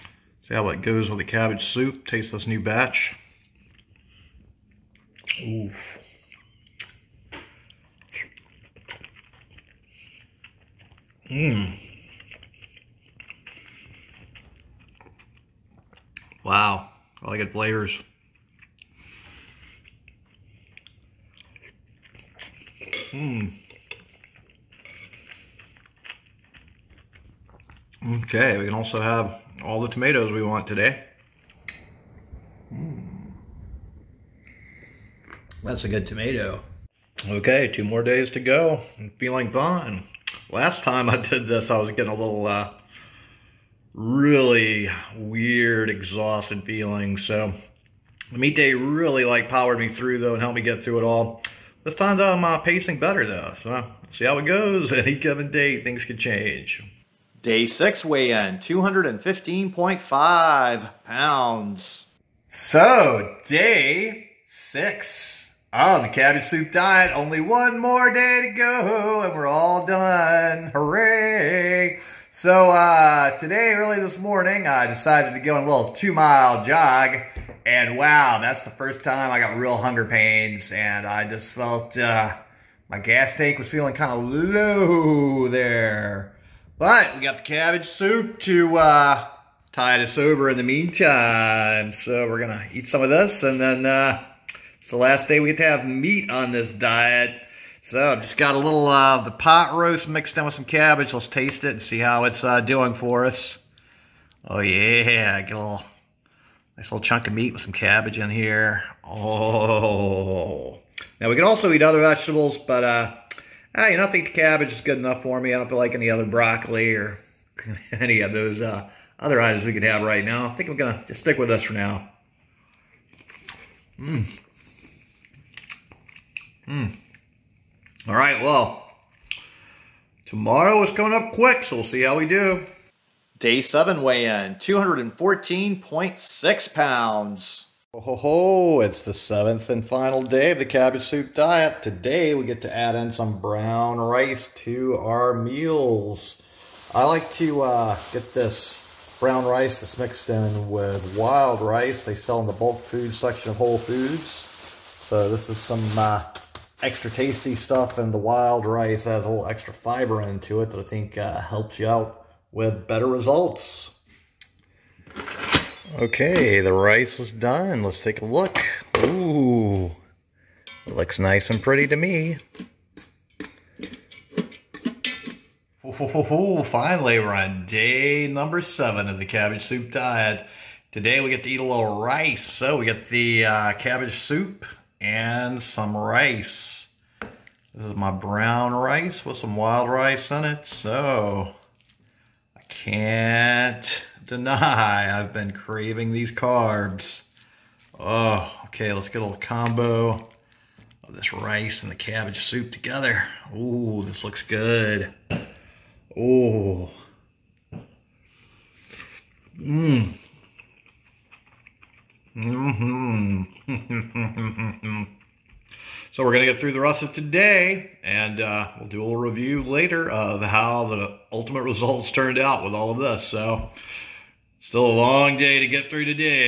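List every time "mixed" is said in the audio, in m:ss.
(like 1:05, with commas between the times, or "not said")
1:40, 2:29.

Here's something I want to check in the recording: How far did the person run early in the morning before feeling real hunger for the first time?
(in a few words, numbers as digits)
2 miles.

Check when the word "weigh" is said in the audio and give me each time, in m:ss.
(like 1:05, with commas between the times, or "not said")
0:58, 2:14.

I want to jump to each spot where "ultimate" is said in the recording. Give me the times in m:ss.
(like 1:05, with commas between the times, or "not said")
3:41.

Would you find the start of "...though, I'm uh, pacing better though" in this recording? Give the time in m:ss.
0:52.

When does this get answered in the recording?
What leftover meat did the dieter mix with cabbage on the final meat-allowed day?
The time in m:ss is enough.
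1:39.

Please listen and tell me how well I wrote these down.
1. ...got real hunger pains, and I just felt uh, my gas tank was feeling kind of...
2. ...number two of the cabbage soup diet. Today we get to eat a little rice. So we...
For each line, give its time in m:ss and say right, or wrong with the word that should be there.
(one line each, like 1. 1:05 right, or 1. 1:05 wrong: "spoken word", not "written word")
1. 1:19 right
2. 2:58 wrong: "seven", not "two".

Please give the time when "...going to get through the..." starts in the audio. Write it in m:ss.
3:36.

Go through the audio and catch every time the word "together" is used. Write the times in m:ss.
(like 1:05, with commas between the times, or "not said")
3:22.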